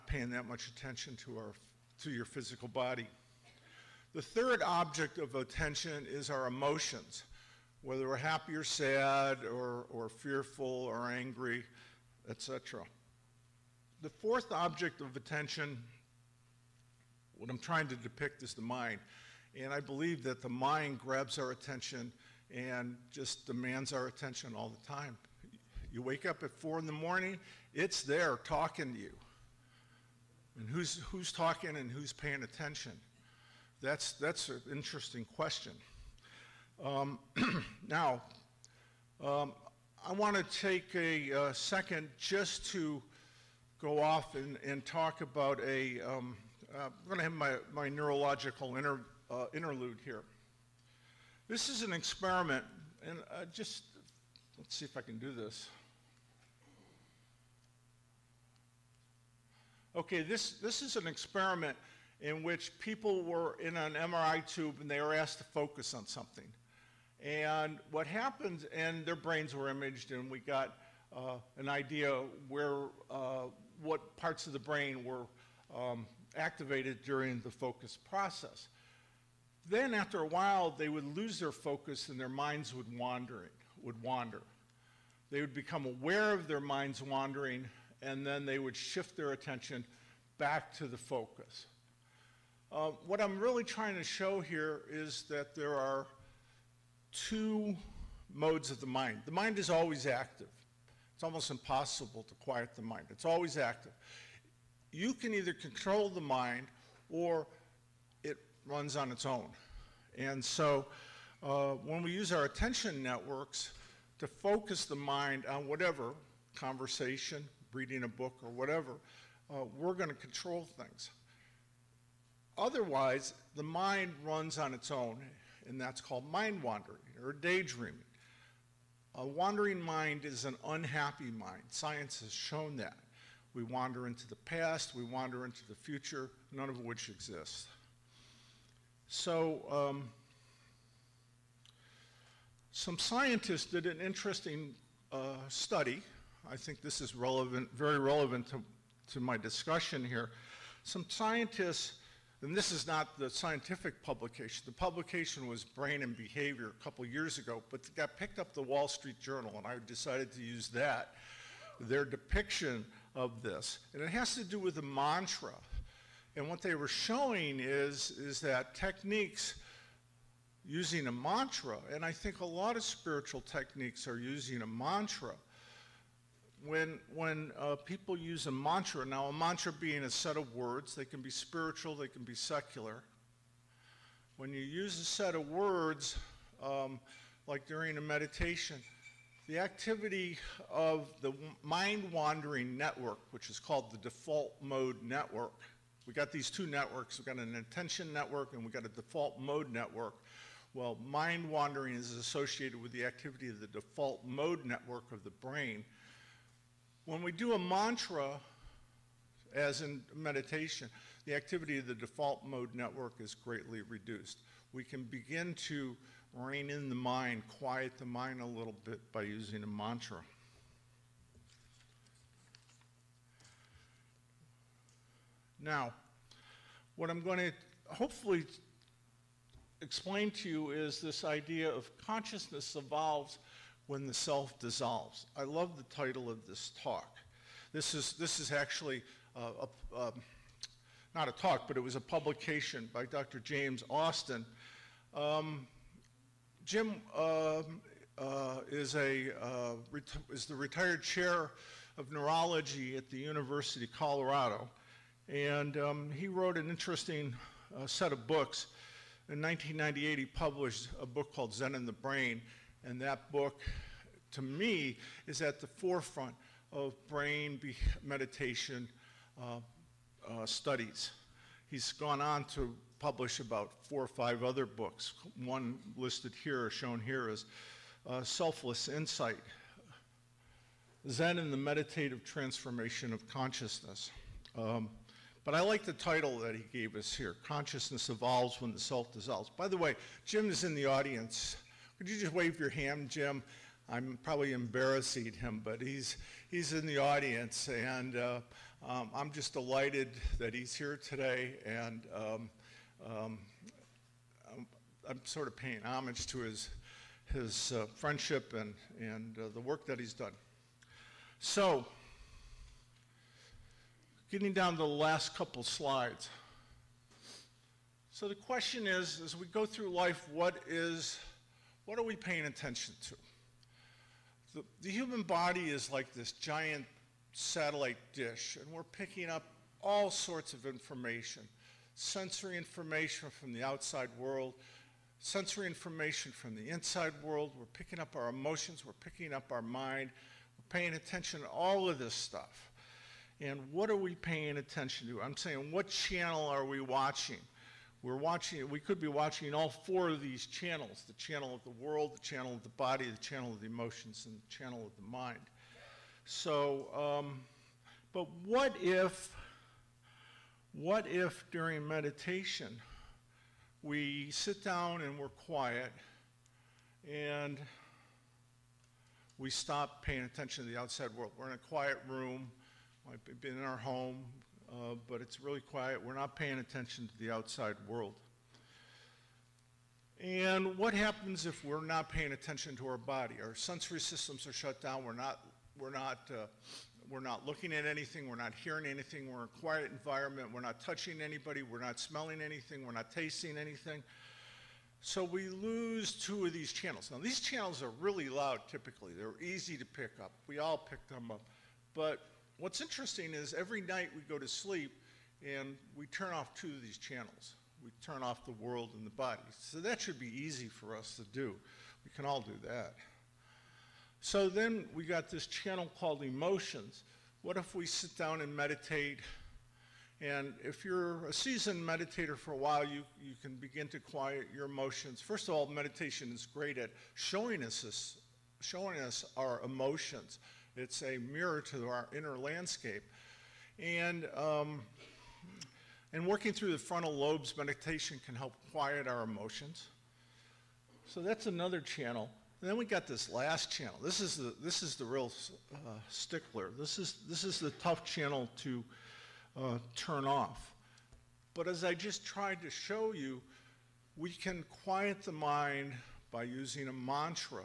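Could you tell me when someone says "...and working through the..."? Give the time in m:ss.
7:16.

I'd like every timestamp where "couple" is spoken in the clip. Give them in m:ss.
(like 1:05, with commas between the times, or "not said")
2:36, 5:15.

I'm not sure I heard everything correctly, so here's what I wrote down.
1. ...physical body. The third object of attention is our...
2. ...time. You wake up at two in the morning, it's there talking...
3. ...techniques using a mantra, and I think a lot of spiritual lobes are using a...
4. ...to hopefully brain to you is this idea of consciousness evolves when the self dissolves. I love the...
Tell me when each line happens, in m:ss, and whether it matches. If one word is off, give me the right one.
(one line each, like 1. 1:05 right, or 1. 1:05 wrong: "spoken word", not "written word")
1. 0:02 right
2. 0:24 wrong: "four", not "two"
3. 2:48 wrong: "techniques", not "lobes"
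4. 3:47 wrong: "explain", not "brain".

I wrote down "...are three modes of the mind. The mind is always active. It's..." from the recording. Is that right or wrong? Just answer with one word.
wrong.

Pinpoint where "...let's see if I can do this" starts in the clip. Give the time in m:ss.
0:54.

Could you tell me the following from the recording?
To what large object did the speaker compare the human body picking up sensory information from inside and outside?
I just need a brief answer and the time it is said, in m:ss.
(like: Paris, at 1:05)
giant satellite dish, at 5:26.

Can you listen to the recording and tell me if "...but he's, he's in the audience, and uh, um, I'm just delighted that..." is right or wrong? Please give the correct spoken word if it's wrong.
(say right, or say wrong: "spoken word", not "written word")
right.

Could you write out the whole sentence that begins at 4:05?
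Um, Jim uh, uh, is, a, uh, is the retired chair of neurology at the University of Colorado.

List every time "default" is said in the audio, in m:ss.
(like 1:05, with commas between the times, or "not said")
3:13, 3:18, 3:23, 3:31.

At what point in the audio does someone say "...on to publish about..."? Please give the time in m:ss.
4:32.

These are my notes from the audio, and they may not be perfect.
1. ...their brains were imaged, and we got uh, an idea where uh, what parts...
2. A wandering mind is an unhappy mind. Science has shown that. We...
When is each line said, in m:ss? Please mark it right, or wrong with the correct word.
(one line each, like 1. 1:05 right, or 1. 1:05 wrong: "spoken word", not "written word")
1. 1:09 right
2. 2:09 right.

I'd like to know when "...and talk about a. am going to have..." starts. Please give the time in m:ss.
0:44.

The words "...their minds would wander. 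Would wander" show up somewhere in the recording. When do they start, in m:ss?
1:22.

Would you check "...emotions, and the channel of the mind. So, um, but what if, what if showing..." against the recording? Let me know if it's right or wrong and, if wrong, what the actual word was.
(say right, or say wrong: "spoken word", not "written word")
wrong: "during", not "showing".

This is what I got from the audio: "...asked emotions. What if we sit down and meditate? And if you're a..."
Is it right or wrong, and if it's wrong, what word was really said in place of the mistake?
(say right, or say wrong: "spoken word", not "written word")
wrong: "called", not "asked".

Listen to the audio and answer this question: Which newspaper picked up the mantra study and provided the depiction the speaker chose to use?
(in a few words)
Wall Street Journal.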